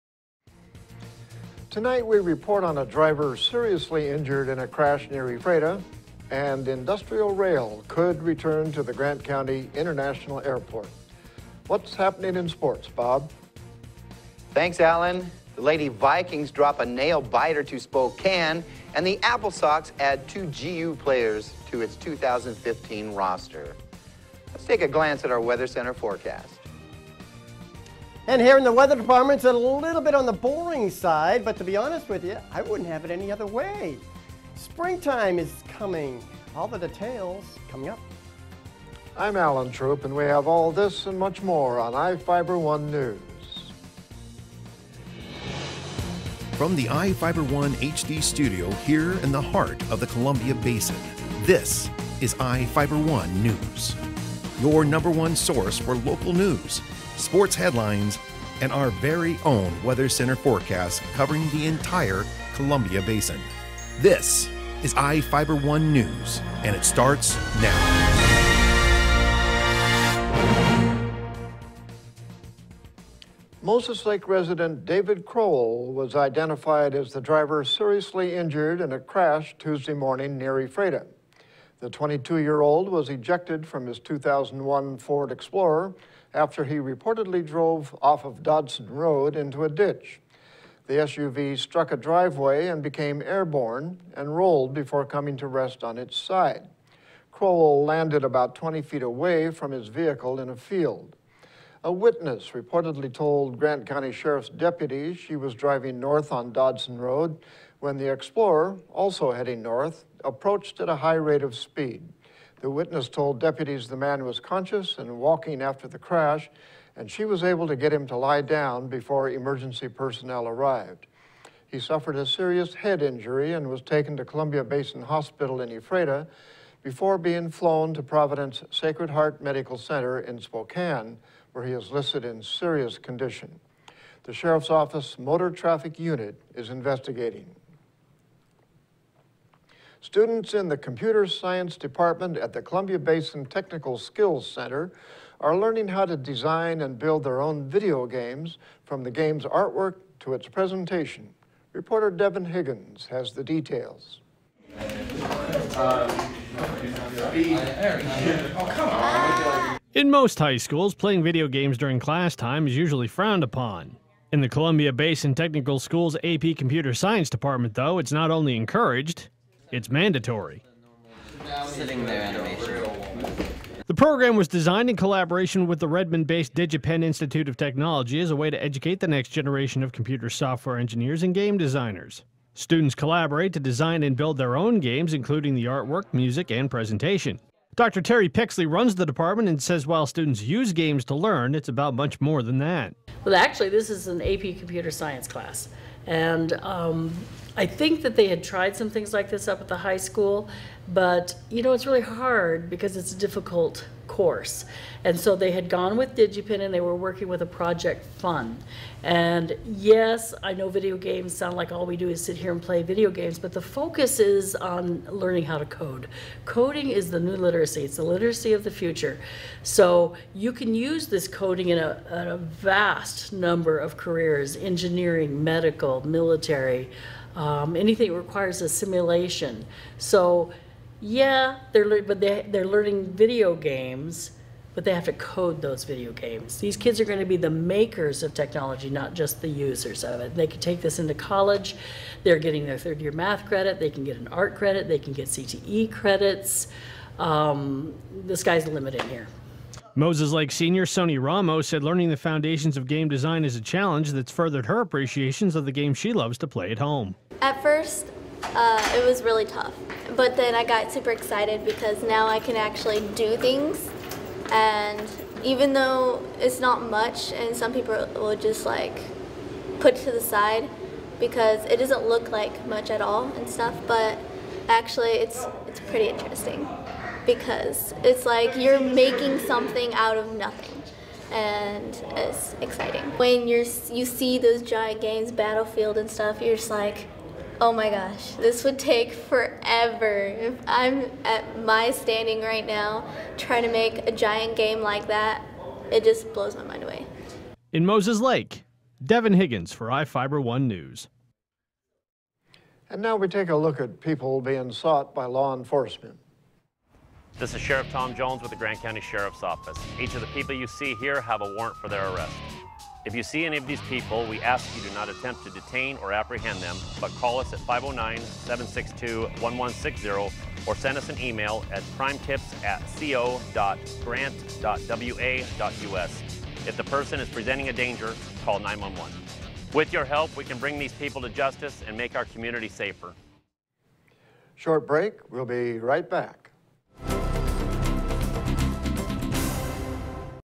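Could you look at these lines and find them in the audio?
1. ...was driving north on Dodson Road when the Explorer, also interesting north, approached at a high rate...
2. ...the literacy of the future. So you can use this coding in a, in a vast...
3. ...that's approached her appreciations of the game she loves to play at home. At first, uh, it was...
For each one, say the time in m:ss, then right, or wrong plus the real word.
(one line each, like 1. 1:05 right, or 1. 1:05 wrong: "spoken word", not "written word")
1. 1:45 wrong: "heading", not "interesting"
2. 3:37 right
3. 4:14 wrong: "furthered", not "approached".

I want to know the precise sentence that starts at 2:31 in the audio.
Reporter Devin Higgins has the details.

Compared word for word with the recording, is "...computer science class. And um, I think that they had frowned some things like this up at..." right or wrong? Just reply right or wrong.
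wrong.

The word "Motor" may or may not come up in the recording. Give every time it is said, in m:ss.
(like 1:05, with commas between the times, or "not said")
2:15.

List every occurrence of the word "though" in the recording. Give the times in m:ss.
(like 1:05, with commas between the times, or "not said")
2:47, 4:25.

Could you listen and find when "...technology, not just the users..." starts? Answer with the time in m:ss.
3:58.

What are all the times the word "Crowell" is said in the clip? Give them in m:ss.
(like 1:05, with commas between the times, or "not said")
1:15, 1:37.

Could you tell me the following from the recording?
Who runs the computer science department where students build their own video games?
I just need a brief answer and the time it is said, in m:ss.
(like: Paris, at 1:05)
Dr. Terry Pixley, at 3:07.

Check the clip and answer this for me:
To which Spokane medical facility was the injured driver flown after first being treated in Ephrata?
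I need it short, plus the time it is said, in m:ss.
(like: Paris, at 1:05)
Providence Sacred Heart Medical Center, at 2:08.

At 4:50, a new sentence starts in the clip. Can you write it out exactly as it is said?
If I'm at my standing right now trying to make a giant game like that, it just blows my mind away.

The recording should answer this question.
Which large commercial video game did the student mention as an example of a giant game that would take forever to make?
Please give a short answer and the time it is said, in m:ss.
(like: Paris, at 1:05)
Battlefield, at 4:45.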